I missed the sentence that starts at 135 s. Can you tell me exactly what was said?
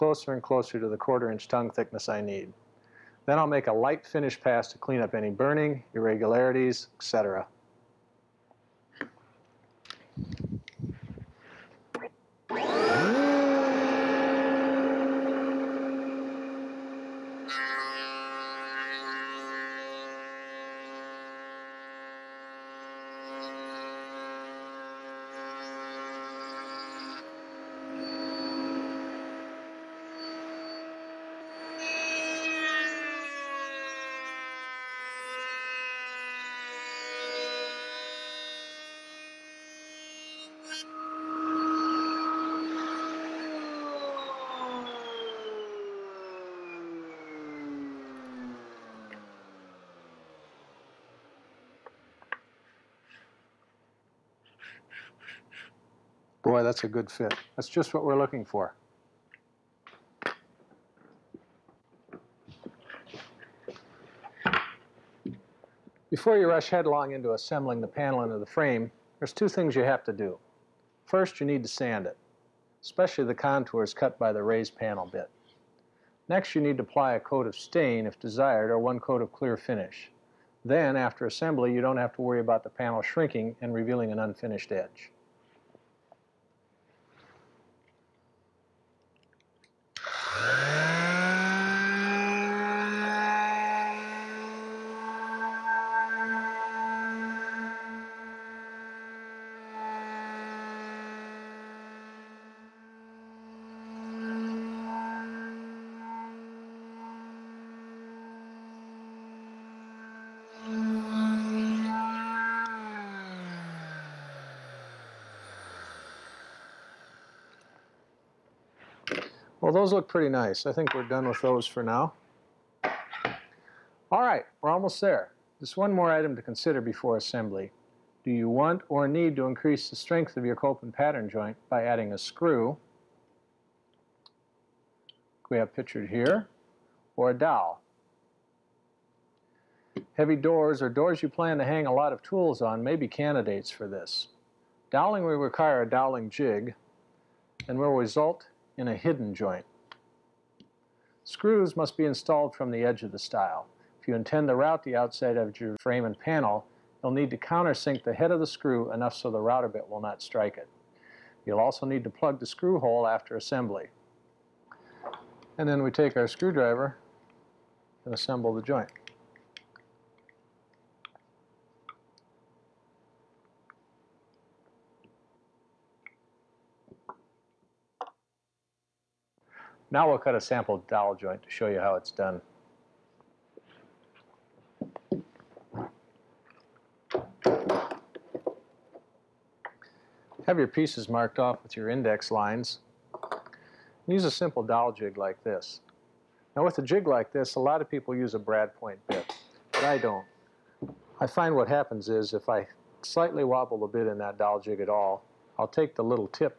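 We have pictured here, or a dowel.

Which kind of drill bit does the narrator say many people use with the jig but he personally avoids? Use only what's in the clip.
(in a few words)
brad point bit.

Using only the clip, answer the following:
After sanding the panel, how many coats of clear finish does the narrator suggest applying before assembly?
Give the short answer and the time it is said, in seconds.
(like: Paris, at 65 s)
1, at 78 s.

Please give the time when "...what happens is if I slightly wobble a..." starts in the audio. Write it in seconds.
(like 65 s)
201 s.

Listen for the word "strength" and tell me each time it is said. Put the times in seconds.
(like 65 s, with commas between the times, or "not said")
129 s.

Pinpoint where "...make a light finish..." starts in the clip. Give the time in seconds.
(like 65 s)
3 s.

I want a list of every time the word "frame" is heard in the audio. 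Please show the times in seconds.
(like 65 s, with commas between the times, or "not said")
68 s, 155 s.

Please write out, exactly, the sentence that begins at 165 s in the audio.
And then we take our screwdriver and assemble the joint.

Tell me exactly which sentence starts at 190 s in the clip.
Have your pieces marked off with your index lines.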